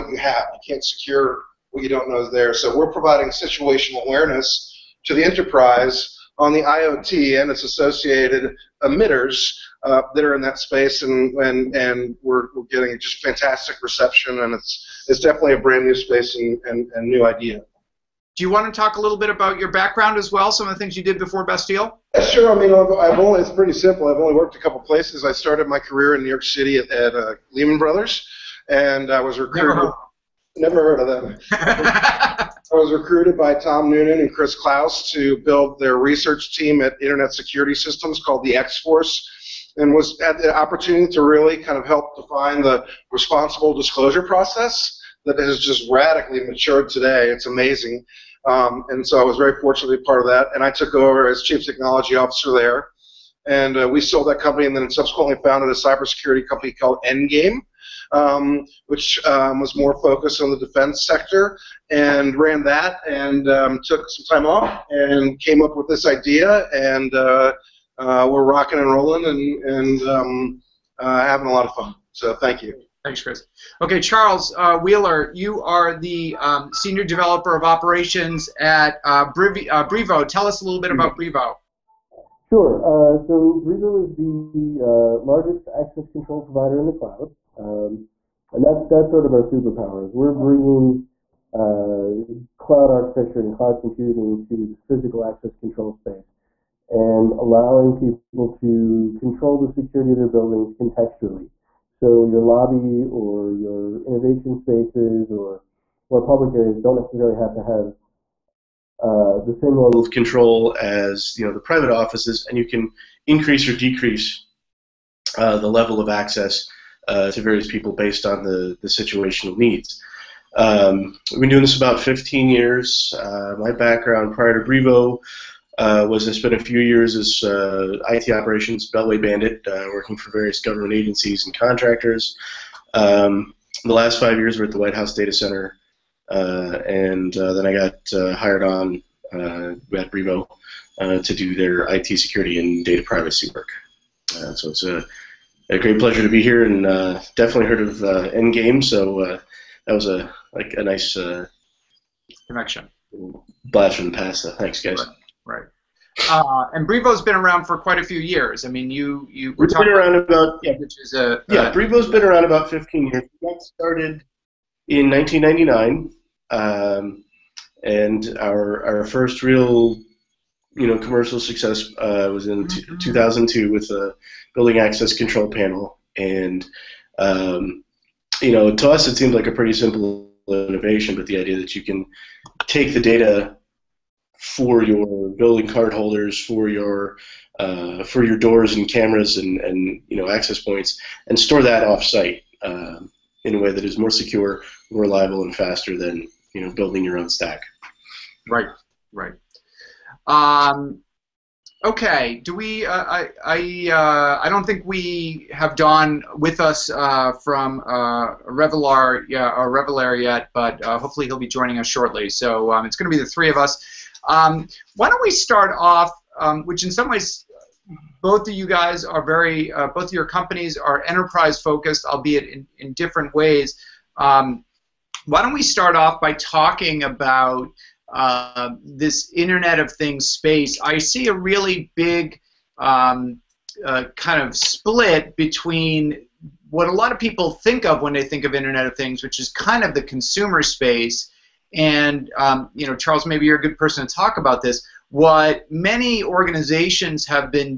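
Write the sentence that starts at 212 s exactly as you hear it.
So um, it's going to be the three of us.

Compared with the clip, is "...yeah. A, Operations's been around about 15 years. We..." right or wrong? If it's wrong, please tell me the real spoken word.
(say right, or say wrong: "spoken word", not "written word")
wrong: "Brivo", not "Operations".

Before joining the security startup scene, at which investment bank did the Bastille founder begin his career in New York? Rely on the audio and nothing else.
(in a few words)
Lehman Brothers.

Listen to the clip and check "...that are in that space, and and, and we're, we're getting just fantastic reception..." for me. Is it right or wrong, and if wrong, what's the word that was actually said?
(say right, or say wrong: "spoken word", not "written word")
right.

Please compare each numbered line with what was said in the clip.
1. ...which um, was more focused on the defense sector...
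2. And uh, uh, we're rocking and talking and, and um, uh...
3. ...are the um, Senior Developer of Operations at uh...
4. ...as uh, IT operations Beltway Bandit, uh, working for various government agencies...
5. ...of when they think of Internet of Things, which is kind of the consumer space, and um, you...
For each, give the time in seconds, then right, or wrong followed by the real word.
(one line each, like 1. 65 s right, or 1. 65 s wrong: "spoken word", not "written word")
1. 58 s right
2. 66 s wrong: "rolling", not "talking"
3. 75 s right
4. 127 s right
5. 237 s right.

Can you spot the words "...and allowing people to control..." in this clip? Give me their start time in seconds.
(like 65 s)
96 s.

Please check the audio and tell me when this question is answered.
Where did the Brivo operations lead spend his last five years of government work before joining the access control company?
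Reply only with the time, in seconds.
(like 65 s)
134 s.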